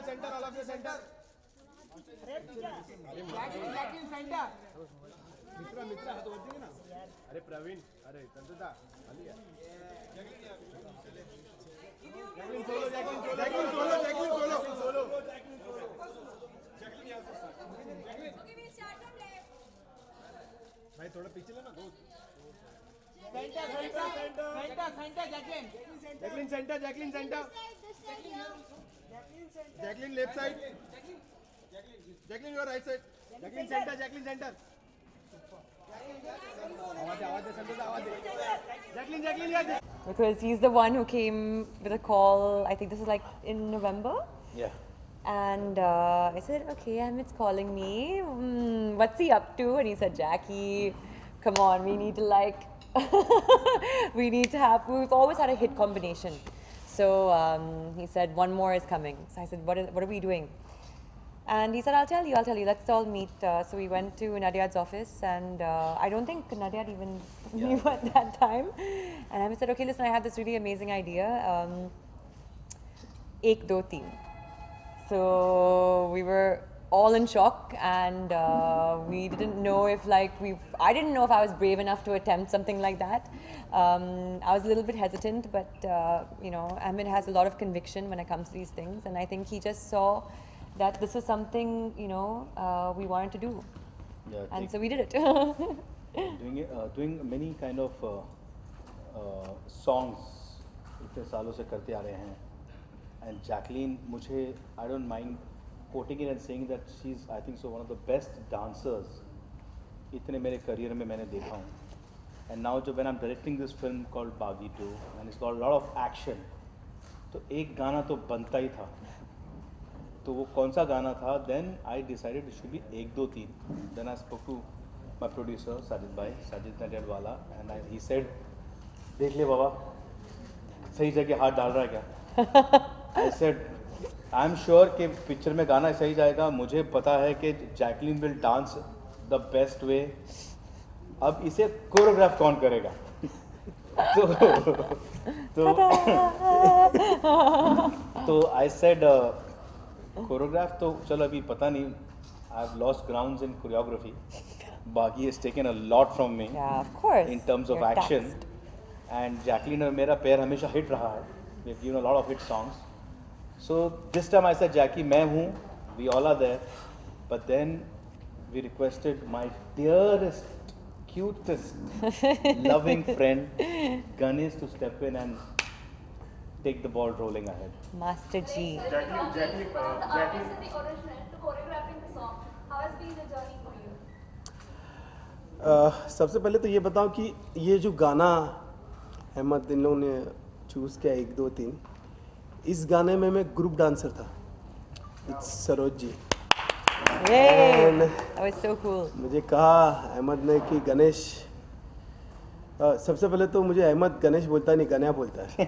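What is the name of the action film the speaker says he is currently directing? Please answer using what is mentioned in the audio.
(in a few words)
Baaghi 2.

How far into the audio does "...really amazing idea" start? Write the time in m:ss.
1:10.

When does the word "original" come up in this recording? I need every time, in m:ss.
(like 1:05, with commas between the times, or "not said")
3:00.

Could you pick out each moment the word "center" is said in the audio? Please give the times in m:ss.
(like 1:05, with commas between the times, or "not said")
0:33, 0:39.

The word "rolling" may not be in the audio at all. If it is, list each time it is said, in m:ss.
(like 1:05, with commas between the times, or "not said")
2:57.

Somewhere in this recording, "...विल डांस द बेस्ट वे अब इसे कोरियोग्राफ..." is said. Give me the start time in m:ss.
2:18.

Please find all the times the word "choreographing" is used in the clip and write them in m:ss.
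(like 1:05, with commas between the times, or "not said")
3:01.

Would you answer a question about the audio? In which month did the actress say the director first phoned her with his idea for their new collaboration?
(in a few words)
November.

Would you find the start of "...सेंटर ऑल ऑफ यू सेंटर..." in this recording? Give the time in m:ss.
0:00.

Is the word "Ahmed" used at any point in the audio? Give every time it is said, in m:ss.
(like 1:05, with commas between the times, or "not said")
0:47, 1:26.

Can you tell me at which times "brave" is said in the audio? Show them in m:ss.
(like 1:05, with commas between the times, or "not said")
1:21.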